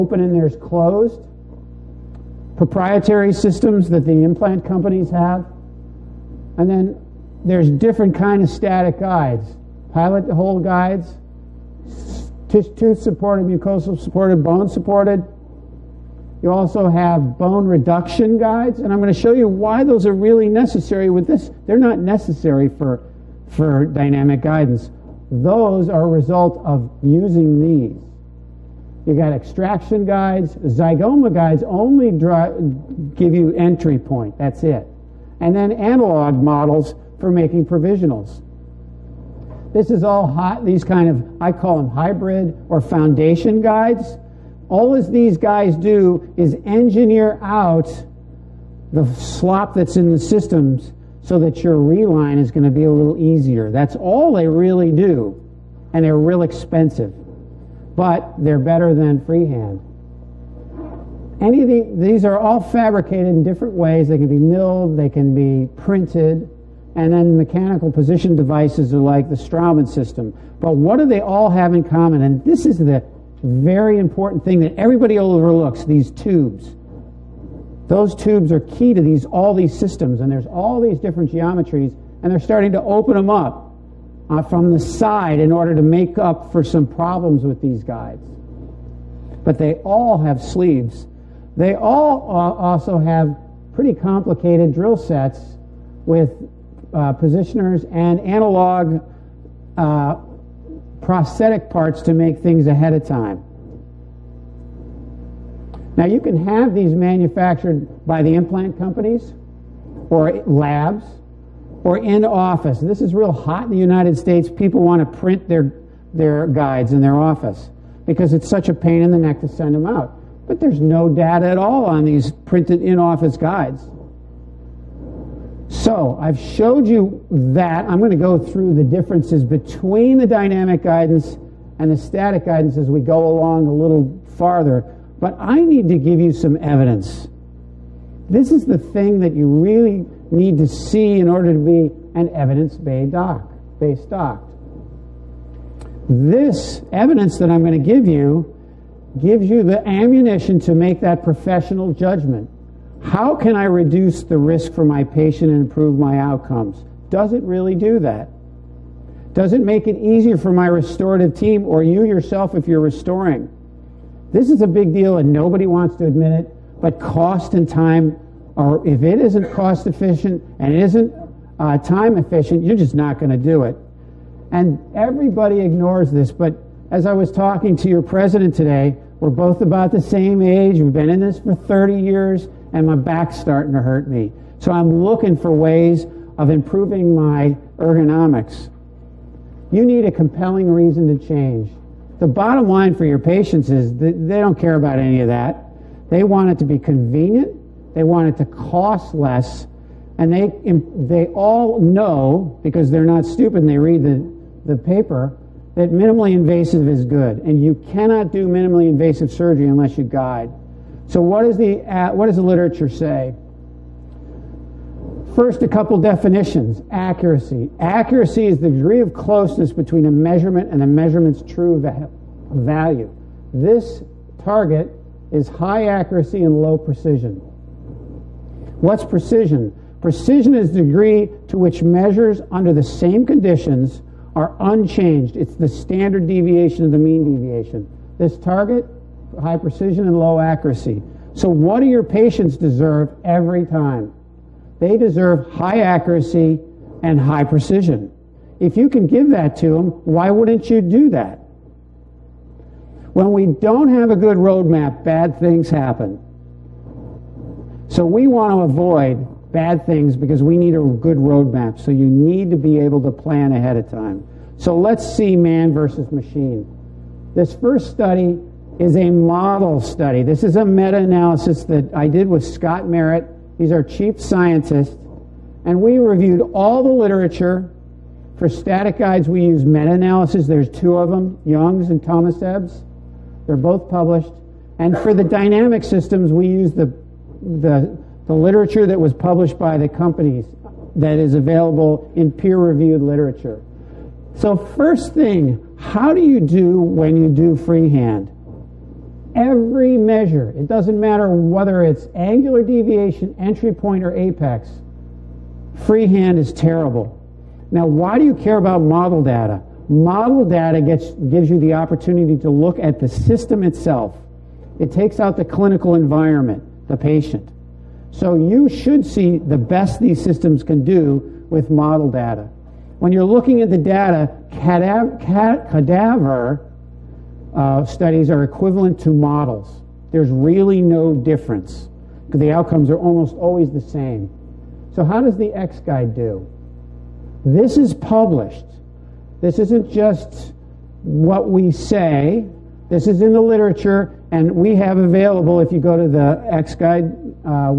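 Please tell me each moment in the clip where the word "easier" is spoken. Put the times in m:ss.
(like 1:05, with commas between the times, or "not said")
0:53, 2:39.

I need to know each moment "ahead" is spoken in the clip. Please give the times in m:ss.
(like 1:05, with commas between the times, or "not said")
1:42, 4:23.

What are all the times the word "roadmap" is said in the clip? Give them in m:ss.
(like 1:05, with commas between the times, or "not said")
4:14, 4:21.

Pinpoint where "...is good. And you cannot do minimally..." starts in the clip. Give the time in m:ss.
3:26.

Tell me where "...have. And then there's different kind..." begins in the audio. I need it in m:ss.
0:05.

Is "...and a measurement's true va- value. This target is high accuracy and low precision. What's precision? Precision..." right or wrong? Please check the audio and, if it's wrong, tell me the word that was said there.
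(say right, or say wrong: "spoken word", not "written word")
right.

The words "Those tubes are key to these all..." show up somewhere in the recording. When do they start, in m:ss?
1:17.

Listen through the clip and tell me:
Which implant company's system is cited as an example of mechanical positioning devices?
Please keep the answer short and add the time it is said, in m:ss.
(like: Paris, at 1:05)
Straumann, at 1:09.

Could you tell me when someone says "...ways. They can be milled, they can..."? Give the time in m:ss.
1:03.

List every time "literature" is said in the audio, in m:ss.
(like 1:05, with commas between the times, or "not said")
3:32, 4:36, 4:48, 4:53, 5:43.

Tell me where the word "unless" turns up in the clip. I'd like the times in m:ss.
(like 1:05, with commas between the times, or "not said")
3:29.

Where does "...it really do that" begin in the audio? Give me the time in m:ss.
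2:37.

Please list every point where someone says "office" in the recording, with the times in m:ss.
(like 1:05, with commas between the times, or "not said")
1:52, 1:57, 2:02.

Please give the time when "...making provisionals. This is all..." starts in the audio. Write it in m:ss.
0:37.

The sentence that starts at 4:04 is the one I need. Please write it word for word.
They deserve high accuracy and high precision.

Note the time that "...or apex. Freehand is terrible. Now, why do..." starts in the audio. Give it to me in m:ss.
5:04.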